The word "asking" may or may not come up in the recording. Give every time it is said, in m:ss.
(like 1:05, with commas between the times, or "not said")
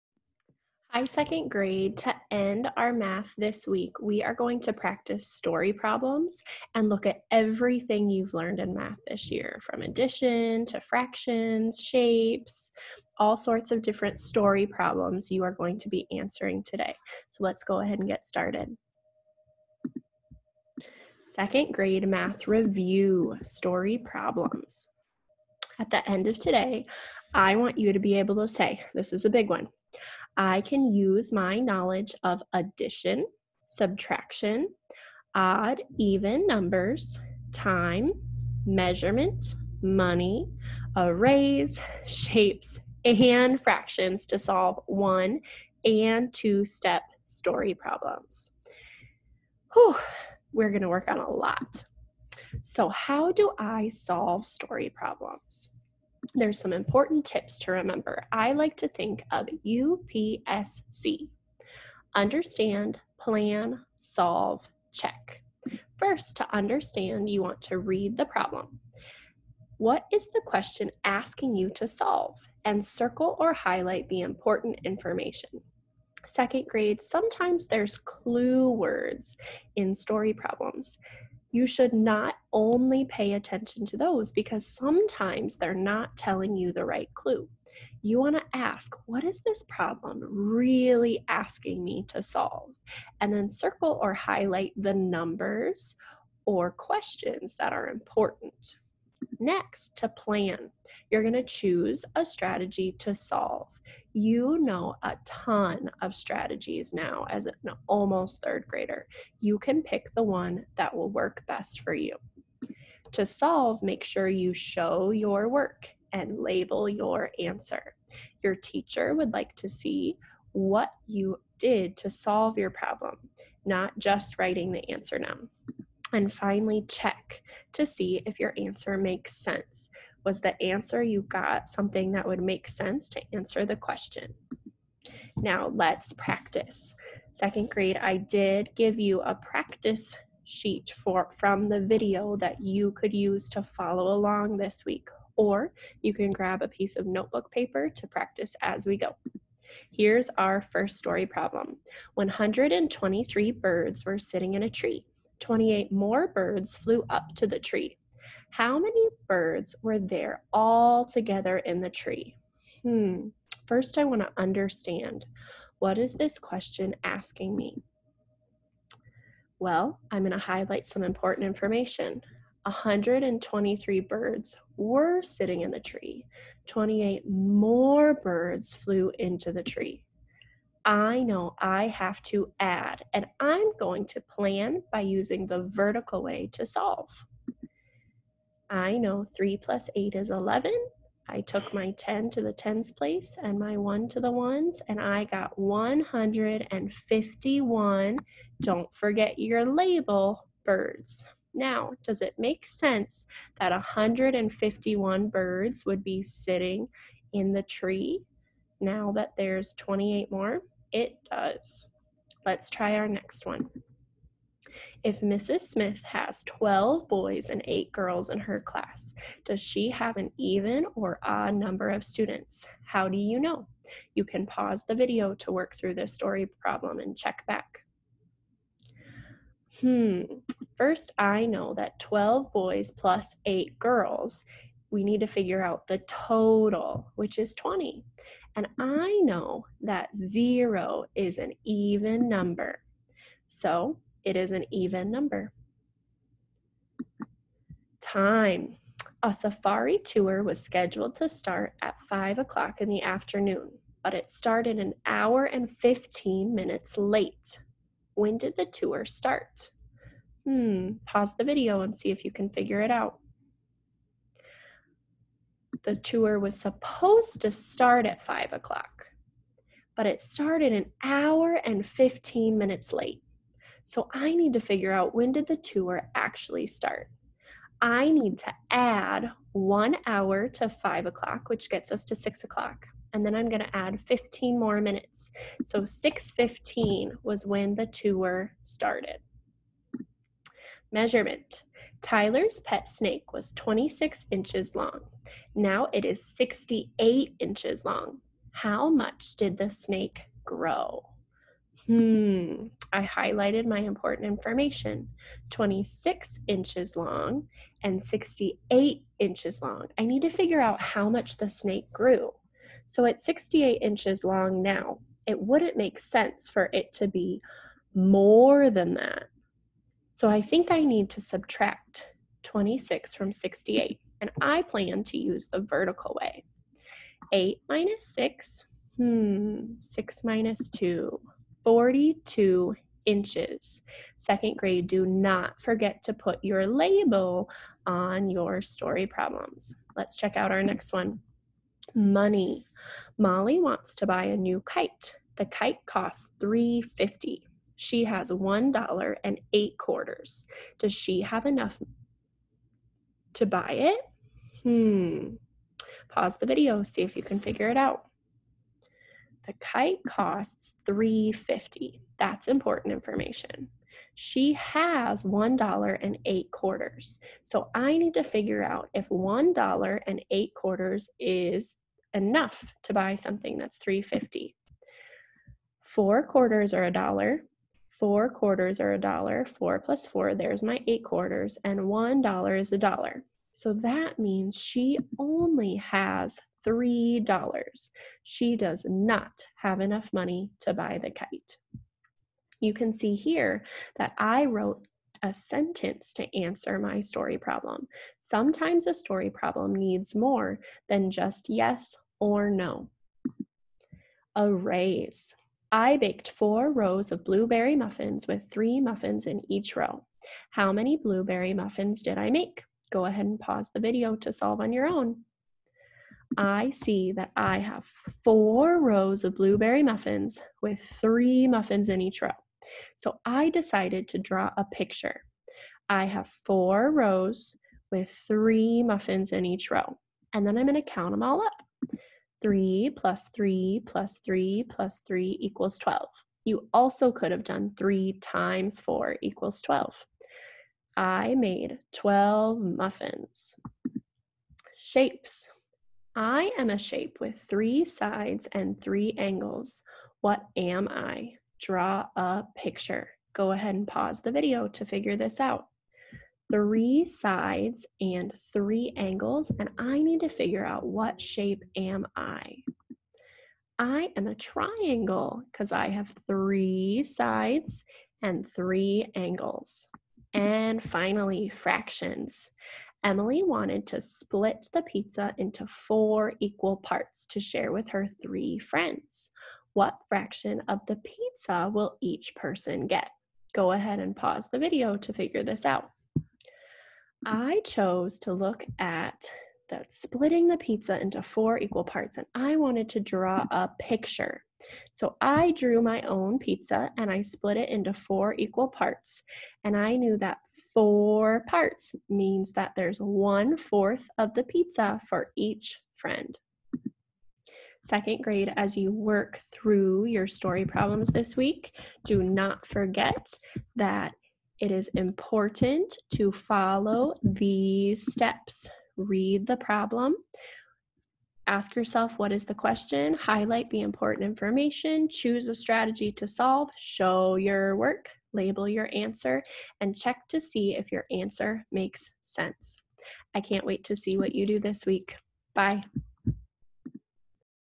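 1:11, 1:31, 2:47.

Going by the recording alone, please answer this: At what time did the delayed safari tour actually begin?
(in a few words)
6:15.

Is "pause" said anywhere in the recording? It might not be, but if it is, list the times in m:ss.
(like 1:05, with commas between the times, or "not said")
3:44, 4:21, 5:56, 6:53, 7:33, 8:04.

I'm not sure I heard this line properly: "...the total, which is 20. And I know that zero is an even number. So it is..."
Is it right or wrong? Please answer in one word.
right.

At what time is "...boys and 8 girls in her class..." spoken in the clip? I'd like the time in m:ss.
3:37.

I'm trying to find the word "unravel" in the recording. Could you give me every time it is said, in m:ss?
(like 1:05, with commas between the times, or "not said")
not said.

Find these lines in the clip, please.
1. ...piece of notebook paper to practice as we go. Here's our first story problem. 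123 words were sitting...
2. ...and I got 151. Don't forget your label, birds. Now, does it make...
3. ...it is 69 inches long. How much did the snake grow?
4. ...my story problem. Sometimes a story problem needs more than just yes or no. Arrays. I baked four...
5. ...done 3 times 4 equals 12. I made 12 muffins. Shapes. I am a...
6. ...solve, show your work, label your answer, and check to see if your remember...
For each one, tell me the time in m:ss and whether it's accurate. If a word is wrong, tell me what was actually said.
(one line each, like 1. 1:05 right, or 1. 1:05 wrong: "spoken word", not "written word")
1. 2:26 wrong: "birds", not "words"
2. 3:14 right
3. 4:55 wrong: "68", not "69"
4. 6:36 right
5. 7:17 right
6. 8:46 wrong: "answer", not "remember".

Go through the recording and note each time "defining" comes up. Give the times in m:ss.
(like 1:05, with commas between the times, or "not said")
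not said.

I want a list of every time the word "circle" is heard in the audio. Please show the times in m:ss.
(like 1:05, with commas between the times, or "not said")
1:12, 1:33.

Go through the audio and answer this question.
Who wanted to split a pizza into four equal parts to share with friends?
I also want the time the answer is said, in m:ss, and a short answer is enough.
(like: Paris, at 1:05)
Emily, at 7:53.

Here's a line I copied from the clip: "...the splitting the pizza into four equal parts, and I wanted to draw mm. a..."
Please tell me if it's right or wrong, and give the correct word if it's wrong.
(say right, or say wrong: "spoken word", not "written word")
right.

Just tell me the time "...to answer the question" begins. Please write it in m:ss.
2:13.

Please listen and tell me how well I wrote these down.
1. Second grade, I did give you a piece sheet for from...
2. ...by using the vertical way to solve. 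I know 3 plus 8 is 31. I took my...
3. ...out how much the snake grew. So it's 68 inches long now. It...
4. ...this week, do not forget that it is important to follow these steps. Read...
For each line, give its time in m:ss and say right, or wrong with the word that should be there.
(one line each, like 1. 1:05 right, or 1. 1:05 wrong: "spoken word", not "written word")
1. 2:17 wrong: "practice", not "piece"
2. 3:04 wrong: "11", not "31"
3. 5:10 right
4. 8:31 right.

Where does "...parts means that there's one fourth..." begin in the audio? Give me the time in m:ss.
8:21.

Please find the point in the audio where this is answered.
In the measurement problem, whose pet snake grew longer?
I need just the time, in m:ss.
4:52.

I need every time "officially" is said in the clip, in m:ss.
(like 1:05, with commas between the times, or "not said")
not said.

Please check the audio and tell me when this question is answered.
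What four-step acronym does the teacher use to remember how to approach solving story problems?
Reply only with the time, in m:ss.
0:59.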